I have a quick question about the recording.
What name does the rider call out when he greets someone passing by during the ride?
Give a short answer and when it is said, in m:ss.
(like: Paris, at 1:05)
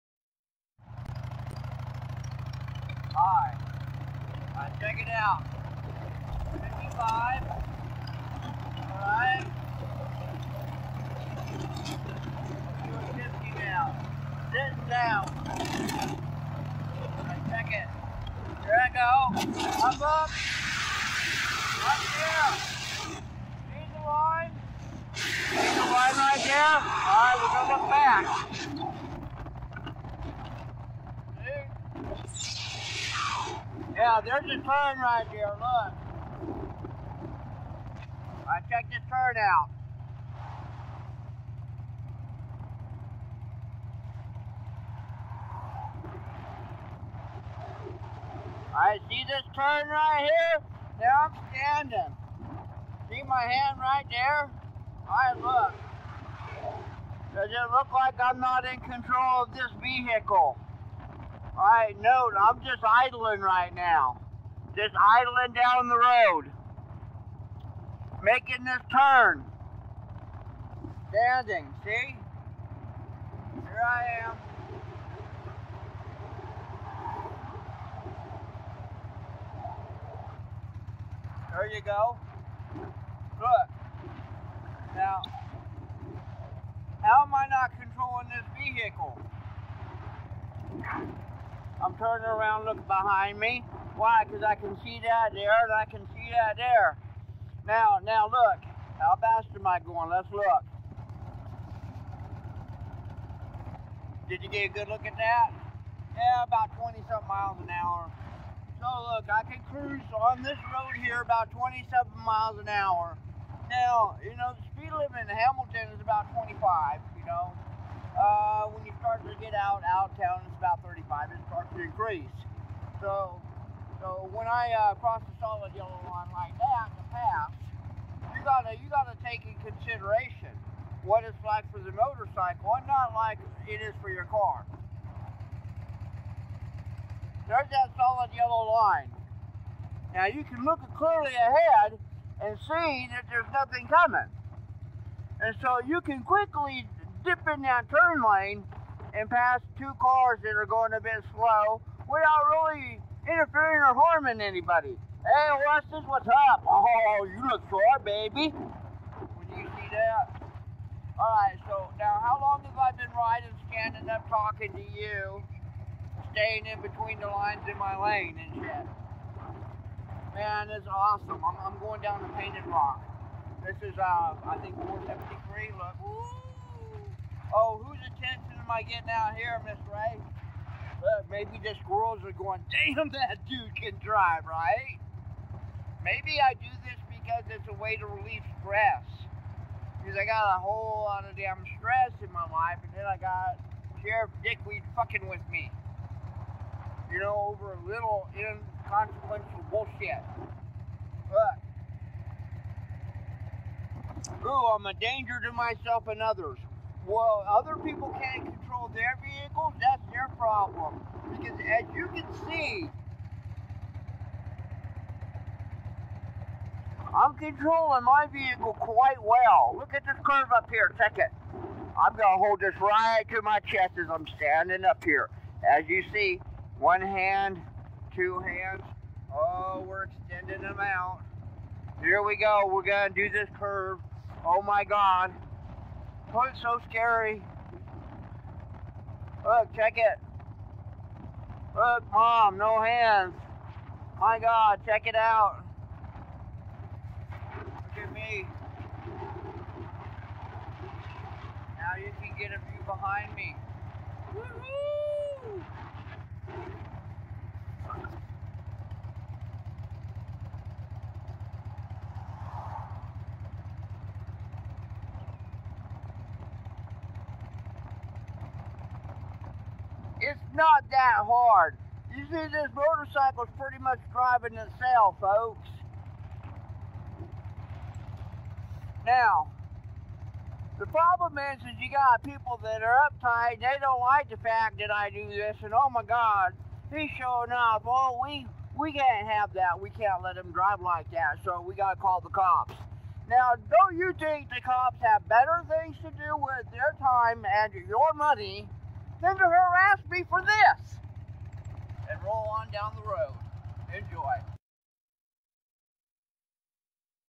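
Weston, at 2:35.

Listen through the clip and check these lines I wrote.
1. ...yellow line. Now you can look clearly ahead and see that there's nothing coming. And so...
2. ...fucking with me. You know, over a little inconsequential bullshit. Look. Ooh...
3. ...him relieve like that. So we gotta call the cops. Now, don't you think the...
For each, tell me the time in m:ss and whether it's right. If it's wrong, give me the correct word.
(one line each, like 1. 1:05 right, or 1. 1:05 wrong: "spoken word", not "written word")
1. 2:18 right
2. 3:14 right
3. 4:50 wrong: "drive", not "relieve".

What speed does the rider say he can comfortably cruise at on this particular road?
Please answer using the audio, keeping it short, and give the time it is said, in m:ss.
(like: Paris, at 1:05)
27 miles an hour, at 1:51.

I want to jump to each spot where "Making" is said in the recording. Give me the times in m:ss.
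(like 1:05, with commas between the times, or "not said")
1:08.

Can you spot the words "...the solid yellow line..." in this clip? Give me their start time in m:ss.
2:05.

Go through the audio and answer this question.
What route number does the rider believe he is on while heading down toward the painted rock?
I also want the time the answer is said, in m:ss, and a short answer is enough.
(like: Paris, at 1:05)
473, at 2:54.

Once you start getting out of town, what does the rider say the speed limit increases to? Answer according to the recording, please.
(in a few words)
35.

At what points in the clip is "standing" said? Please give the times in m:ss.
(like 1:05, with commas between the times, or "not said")
0:51, 1:11, 2:43, 3:44.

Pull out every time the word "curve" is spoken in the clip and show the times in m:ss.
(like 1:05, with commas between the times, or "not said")
3:40, 3:53.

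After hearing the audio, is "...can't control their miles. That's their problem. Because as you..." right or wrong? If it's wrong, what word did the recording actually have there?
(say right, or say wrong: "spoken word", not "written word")
wrong: "vehicles", not "miles".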